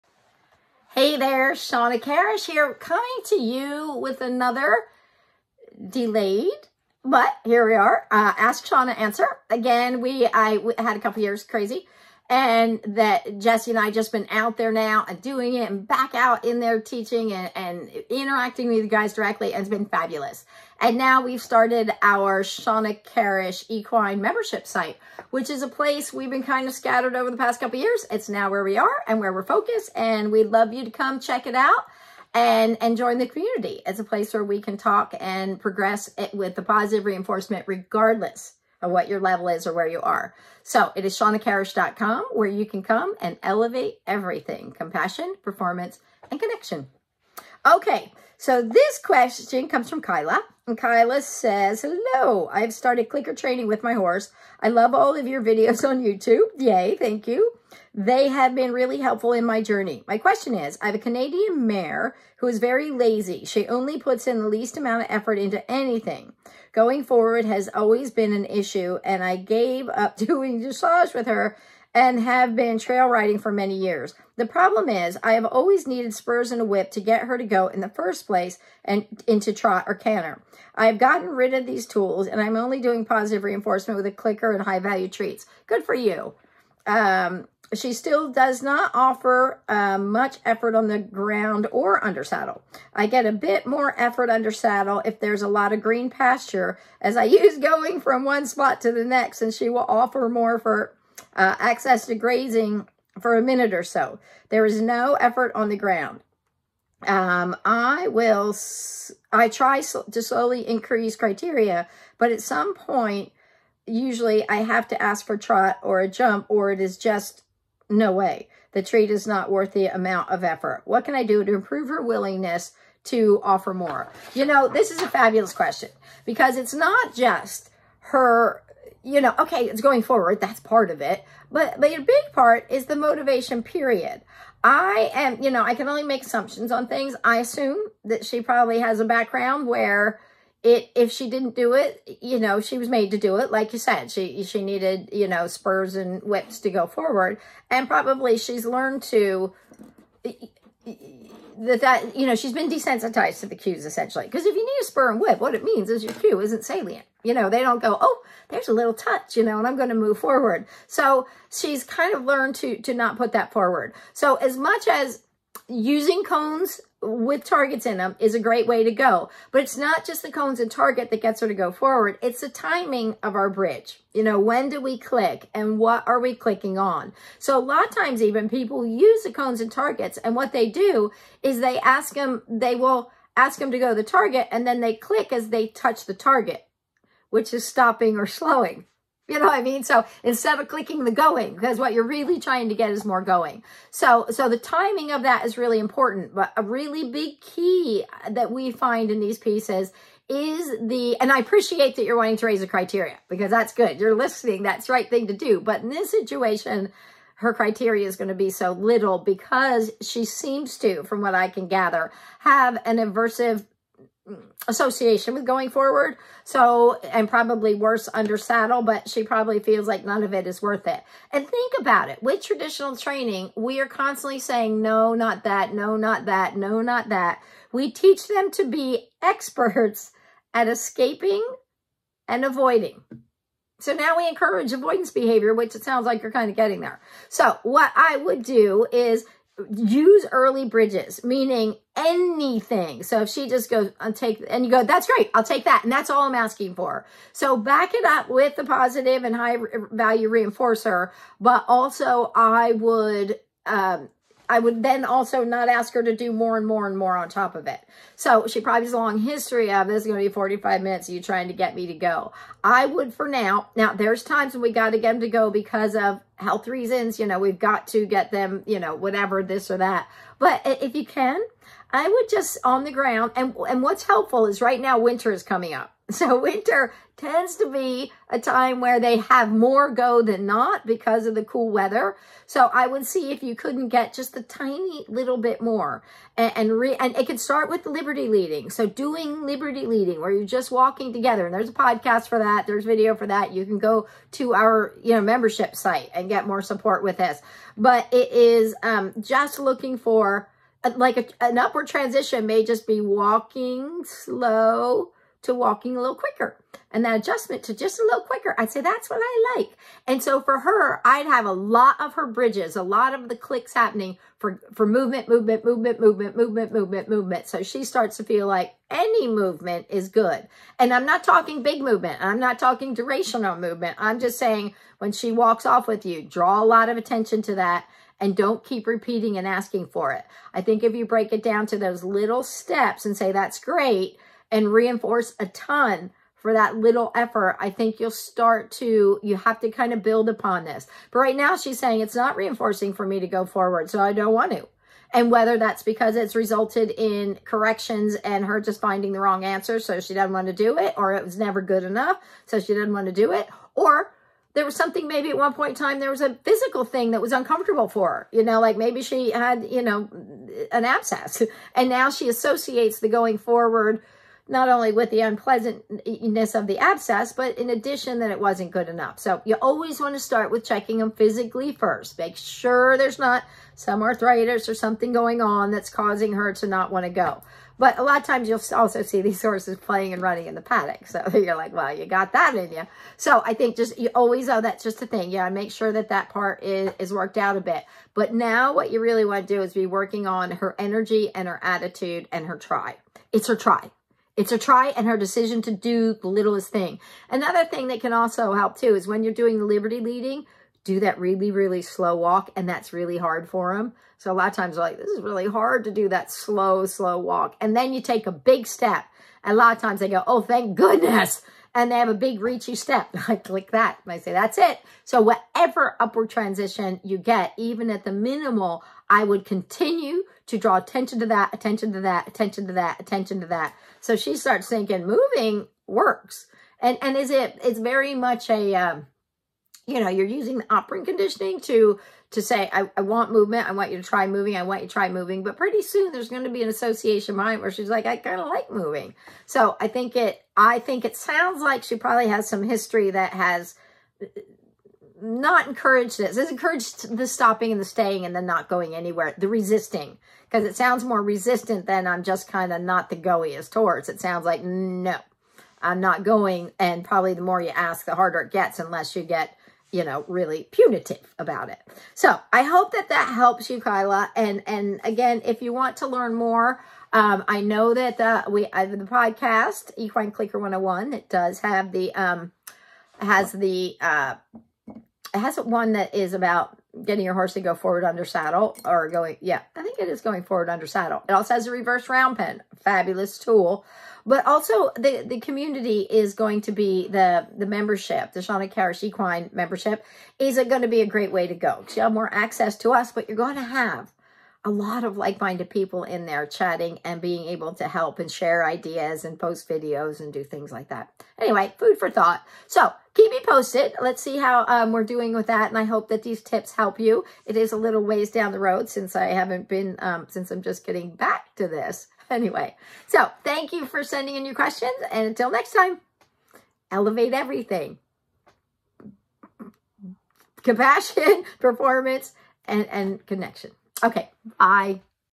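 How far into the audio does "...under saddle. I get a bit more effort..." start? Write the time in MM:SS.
01:32.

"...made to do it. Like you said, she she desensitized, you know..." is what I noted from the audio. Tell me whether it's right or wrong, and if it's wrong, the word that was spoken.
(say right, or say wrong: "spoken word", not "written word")
wrong: "needed", not "desensitized".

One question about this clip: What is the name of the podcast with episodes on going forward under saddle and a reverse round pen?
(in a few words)
Equine Clicker 101.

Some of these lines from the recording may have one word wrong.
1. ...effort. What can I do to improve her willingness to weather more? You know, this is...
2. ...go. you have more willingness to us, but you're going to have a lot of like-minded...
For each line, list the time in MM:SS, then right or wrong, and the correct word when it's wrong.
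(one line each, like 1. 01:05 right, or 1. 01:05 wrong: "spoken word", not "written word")
1. 02:00 wrong: "offer", not "weather"
2. 08:11 wrong: "access", not "willingness".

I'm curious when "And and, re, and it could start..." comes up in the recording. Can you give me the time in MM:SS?
04:46.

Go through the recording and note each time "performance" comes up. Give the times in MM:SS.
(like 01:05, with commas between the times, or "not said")
00:45, 08:41.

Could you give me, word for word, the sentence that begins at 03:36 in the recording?
So, and probably worse under saddle, but she probably feels like none of it is worth it.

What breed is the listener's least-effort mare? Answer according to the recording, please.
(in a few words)
Canadian.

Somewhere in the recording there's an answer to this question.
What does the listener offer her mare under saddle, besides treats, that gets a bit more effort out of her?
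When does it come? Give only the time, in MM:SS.
01:41.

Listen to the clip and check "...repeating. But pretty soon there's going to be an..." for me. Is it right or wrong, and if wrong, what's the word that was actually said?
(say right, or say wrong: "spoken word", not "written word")
wrong: "moving", not "repeating".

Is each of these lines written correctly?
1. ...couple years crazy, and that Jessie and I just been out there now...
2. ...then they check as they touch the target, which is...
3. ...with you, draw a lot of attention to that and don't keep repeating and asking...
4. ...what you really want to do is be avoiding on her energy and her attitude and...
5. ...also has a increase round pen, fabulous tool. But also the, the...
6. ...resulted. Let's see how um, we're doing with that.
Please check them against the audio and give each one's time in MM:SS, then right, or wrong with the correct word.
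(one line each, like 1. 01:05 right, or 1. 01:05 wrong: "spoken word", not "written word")
1. 00:10 right
2. 03:04 wrong: "click", not "check"
3. 05:25 right
4. 06:28 wrong: "working", not "avoiding"
5. 08:01 wrong: "reverse", not "increase"
6. 08:23 wrong: "posted", not "resulted".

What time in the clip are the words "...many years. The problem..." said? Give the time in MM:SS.
01:13.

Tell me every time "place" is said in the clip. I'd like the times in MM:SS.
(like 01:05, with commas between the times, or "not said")
00:25, 00:34, 01:18.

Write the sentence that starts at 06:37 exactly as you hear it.
Another thing that can also help too is when you're doing the liberty leading, do that really, really slow walk.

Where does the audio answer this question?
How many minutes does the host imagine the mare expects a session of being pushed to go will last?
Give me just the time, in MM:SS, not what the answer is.
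04:20.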